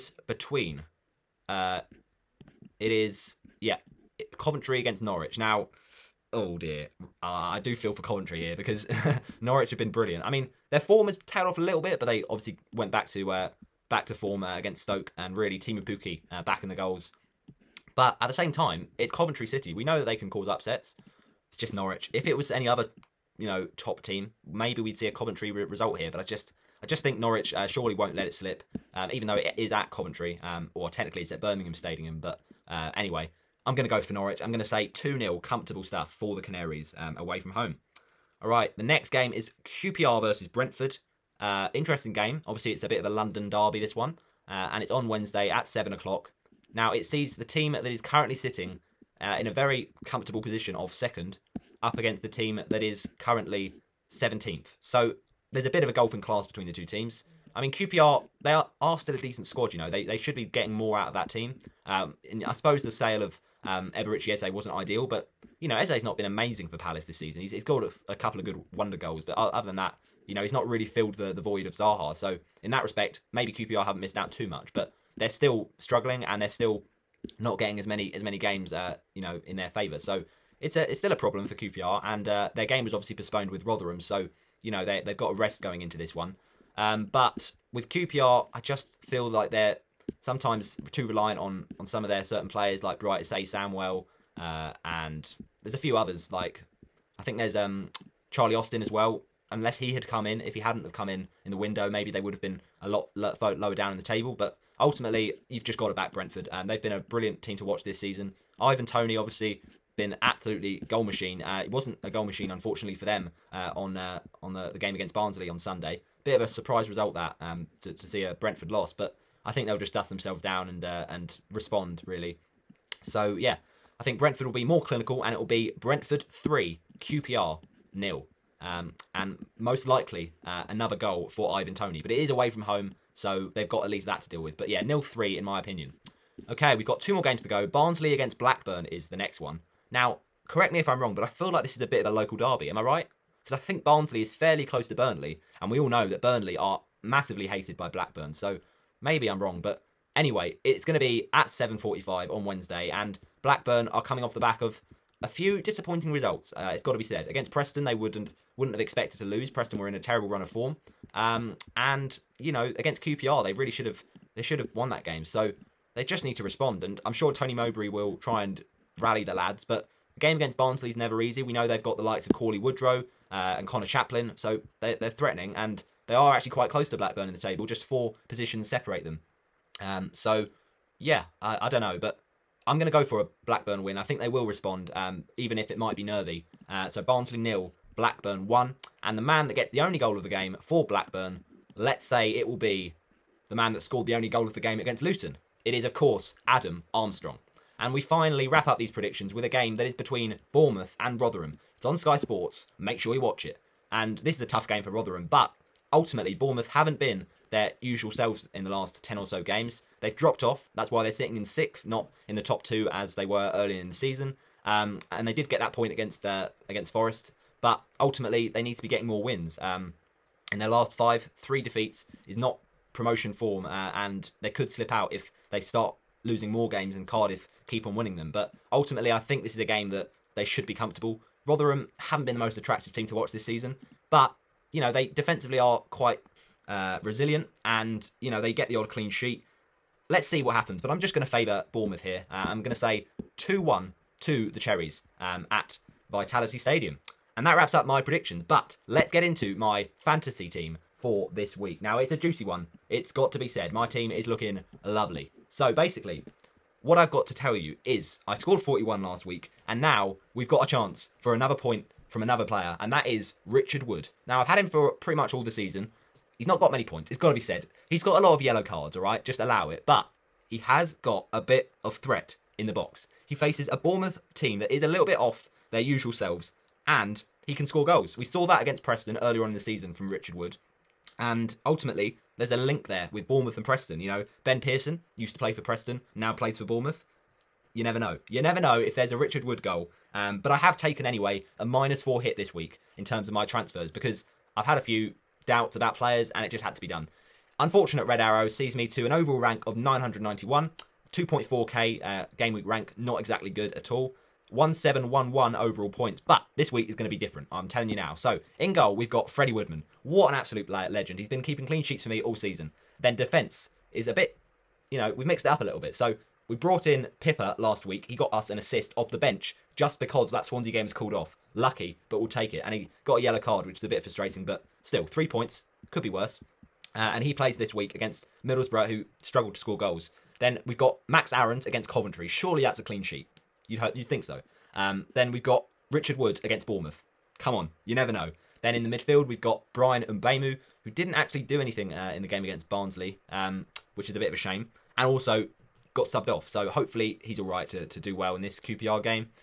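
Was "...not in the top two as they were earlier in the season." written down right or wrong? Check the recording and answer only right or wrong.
right.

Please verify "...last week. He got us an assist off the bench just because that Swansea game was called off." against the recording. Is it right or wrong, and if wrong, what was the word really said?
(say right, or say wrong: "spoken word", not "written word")
right.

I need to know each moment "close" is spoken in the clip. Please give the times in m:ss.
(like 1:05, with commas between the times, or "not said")
2:24, 2:56.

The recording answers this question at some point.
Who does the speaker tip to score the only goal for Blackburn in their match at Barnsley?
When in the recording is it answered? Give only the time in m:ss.
3:16.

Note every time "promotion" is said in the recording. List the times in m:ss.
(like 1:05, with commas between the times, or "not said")
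3:42.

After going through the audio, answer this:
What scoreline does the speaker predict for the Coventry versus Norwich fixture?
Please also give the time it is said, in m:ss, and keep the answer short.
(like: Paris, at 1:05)
2-0, at 0:34.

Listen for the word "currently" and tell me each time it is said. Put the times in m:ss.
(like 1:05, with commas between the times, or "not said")
0:48, 0:53.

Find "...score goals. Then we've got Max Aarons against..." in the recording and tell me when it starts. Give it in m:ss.
5:29.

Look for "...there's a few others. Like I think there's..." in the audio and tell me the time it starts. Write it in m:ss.
1:35.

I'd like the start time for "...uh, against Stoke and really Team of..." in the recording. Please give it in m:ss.
0:14.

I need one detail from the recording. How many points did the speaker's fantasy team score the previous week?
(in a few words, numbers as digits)
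41.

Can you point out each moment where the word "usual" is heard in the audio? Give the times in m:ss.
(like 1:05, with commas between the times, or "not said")
3:27, 4:35.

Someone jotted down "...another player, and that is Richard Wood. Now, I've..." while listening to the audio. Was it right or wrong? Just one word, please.
right.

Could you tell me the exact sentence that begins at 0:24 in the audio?
Maybe we'd see a Coventry re result here, but I just, I just think Norwich uh, surely won't let it slip.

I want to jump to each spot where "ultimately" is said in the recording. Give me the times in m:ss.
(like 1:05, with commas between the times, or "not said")
1:44, 3:25, 3:37, 3:48, 4:41.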